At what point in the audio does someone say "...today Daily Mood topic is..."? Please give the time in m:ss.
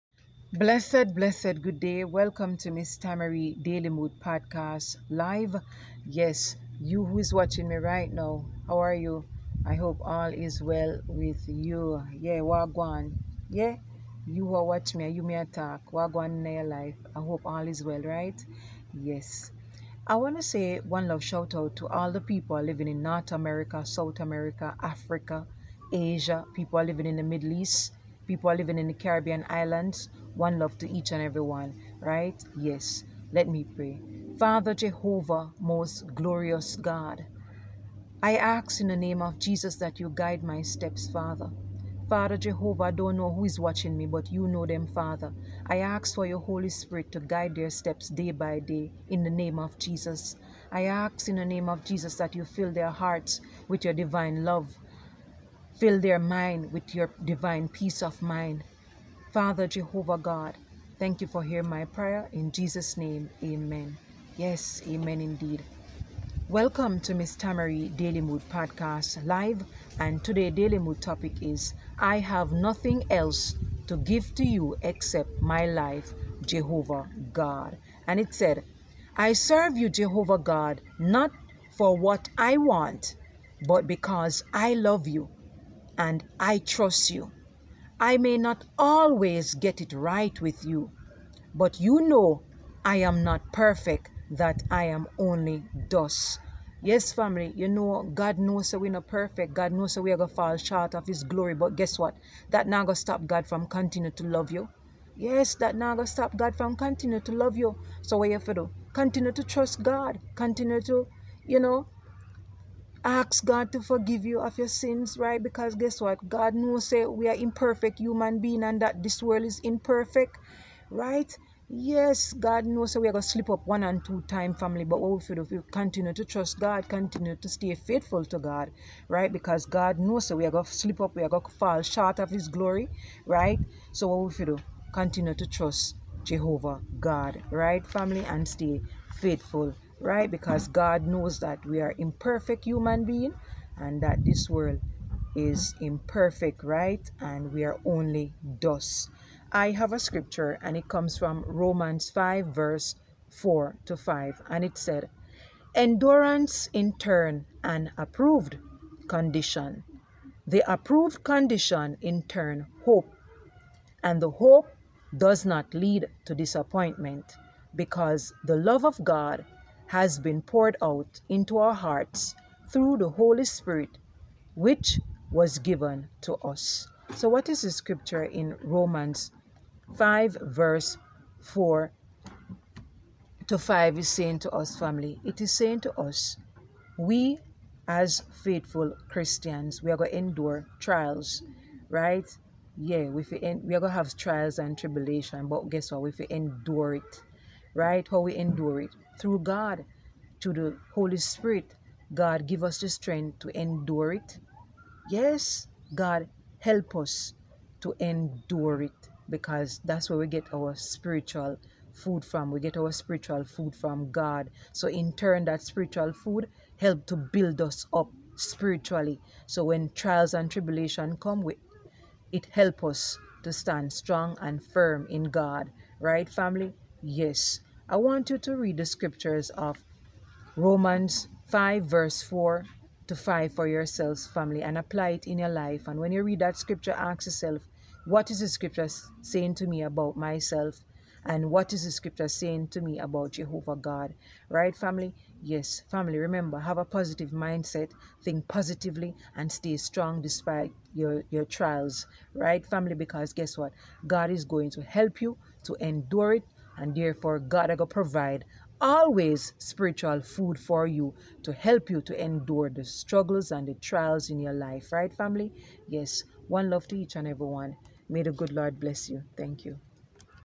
1:10.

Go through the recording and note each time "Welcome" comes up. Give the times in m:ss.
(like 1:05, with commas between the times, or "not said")
0:02, 1:06.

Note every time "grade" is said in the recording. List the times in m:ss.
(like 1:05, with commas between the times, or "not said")
not said.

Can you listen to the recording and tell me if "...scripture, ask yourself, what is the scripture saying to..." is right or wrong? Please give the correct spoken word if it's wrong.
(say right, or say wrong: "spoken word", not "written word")
right.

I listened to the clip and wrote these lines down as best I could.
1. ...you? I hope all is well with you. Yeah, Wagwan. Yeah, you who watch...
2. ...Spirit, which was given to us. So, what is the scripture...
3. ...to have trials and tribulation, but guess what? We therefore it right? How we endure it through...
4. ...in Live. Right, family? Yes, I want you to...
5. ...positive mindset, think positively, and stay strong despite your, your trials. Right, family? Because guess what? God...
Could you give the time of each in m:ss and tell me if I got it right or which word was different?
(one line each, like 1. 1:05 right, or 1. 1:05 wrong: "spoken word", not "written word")
1. 0:08 right
2. 2:53 right
3. 3:13 wrong: "endure", not "therefore"
4. 3:45 wrong: "God", not "Live"
5. 4:06 right.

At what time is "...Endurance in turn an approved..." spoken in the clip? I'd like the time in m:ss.
2:35.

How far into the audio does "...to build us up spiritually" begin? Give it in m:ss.
3:37.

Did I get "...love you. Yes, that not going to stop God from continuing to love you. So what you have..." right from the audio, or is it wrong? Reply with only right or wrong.
right.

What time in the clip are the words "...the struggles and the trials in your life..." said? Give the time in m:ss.
4:22.